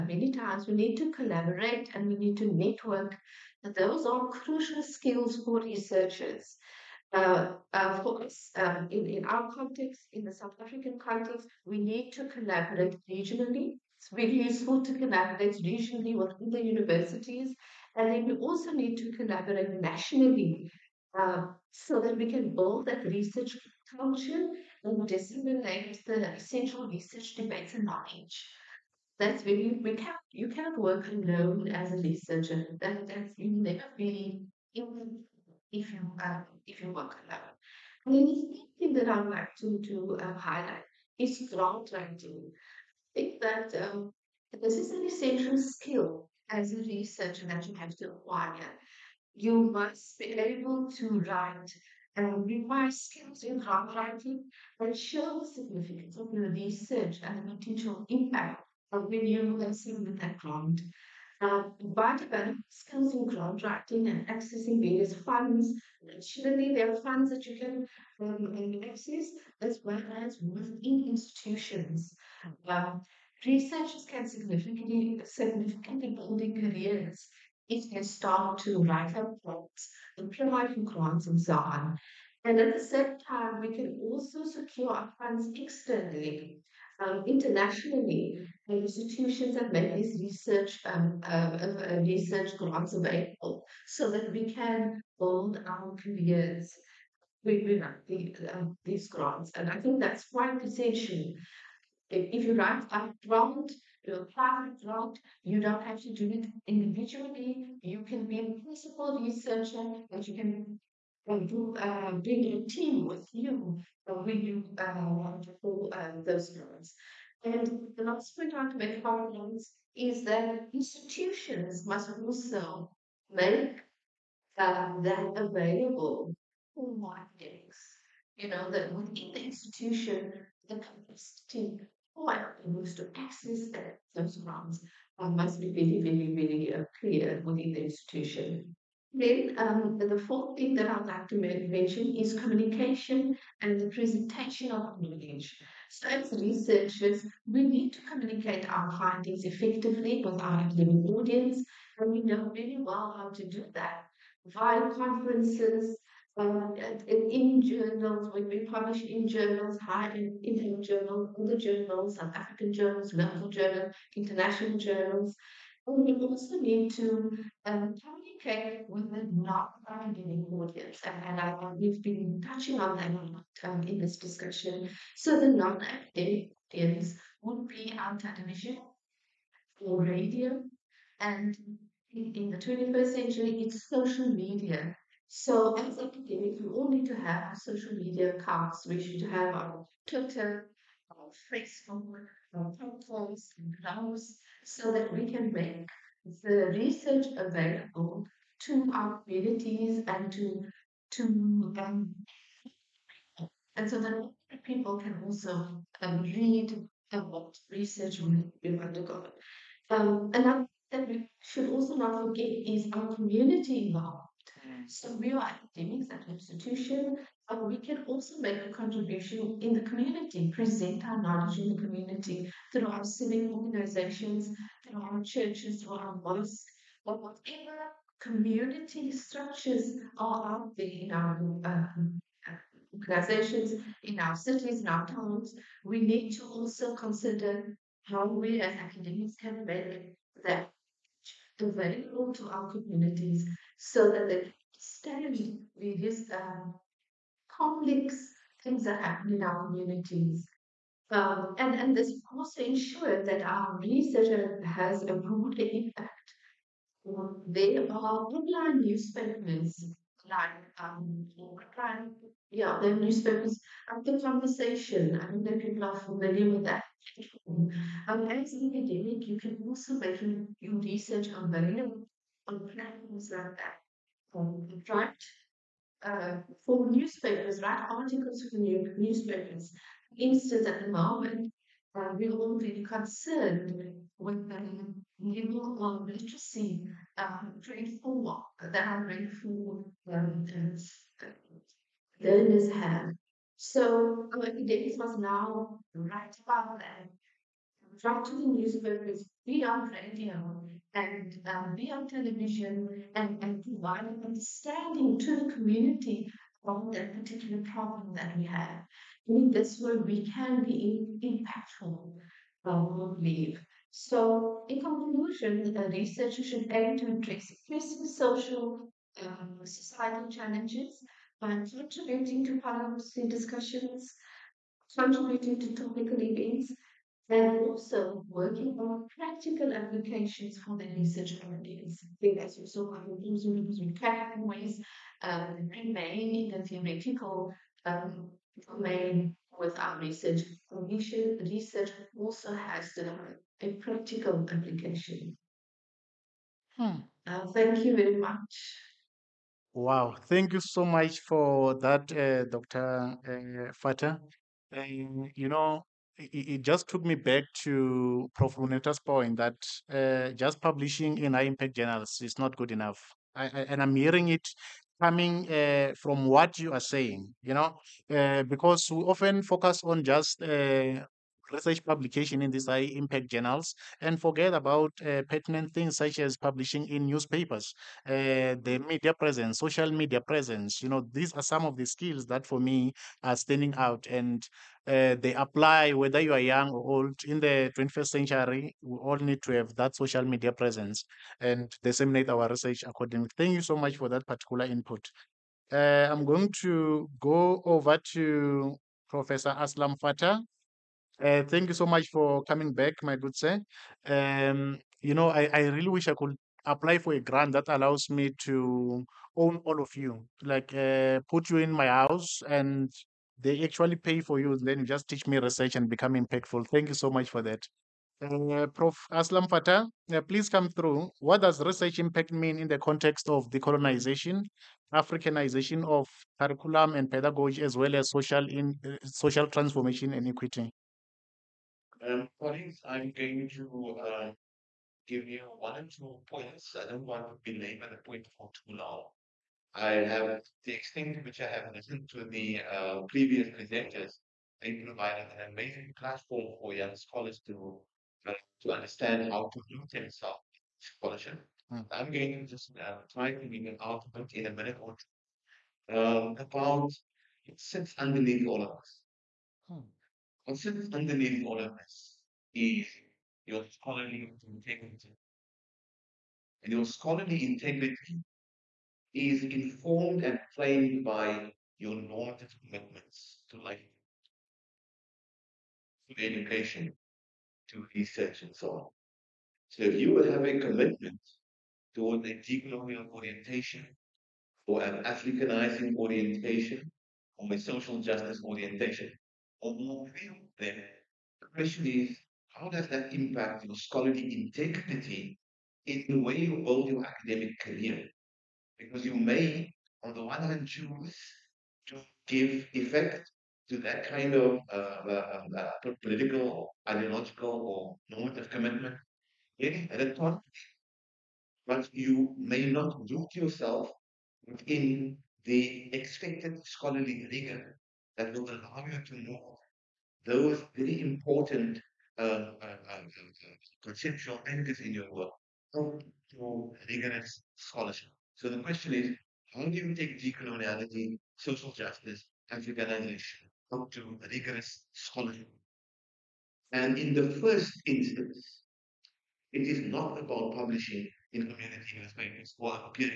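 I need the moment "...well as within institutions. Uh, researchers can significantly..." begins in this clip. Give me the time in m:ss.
1:09.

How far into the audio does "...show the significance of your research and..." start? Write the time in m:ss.
0:54.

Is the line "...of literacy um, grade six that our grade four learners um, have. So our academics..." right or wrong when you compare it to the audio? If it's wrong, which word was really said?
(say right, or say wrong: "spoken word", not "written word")
wrong: "four", not "six".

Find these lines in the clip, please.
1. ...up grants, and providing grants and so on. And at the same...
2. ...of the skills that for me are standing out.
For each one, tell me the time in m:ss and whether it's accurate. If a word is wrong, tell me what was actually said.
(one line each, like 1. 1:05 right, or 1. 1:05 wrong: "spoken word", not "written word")
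1. 1:19 right
2. 6:21 right.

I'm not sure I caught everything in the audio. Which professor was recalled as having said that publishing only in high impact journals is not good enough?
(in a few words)
Prof. Luneta.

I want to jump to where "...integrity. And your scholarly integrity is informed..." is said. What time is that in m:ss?
7:44.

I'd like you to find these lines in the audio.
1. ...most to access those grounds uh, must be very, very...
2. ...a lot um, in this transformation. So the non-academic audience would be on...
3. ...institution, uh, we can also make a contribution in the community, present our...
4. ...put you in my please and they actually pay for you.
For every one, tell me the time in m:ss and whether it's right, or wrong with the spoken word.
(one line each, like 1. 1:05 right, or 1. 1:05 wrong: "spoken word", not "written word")
1. 2:12 right
2. 2:53 wrong: "discussion", not "transformation"
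3. 3:36 right
4. 6:51 wrong: "house", not "please".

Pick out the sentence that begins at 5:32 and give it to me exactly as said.
I think as you saw, I was using ways um, remain in the theoretical um, domain with our research.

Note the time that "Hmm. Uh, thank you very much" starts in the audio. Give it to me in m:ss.
5:46.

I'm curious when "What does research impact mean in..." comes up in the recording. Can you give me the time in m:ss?
7:01.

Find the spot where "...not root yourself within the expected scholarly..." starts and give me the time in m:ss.
8:32.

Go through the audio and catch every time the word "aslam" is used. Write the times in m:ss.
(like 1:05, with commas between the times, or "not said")
6:39, 6:59.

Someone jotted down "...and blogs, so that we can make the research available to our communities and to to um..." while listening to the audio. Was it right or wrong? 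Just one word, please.
right.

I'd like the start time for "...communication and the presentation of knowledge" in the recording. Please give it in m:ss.
2:22.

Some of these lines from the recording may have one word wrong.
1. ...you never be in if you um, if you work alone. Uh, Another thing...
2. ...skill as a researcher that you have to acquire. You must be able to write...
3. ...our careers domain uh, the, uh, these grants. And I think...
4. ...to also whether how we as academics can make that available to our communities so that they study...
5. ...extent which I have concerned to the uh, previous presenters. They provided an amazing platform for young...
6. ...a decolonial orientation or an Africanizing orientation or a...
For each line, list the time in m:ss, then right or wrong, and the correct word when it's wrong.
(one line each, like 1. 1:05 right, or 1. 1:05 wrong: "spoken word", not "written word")
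1. 0:33 right
2. 0:45 right
3. 1:35 wrong: "within", not "domain"
4. 3:56 wrong: "consider", not "whether"
5. 7:20 wrong: "listened", not "concerned"
6. 8:02 right.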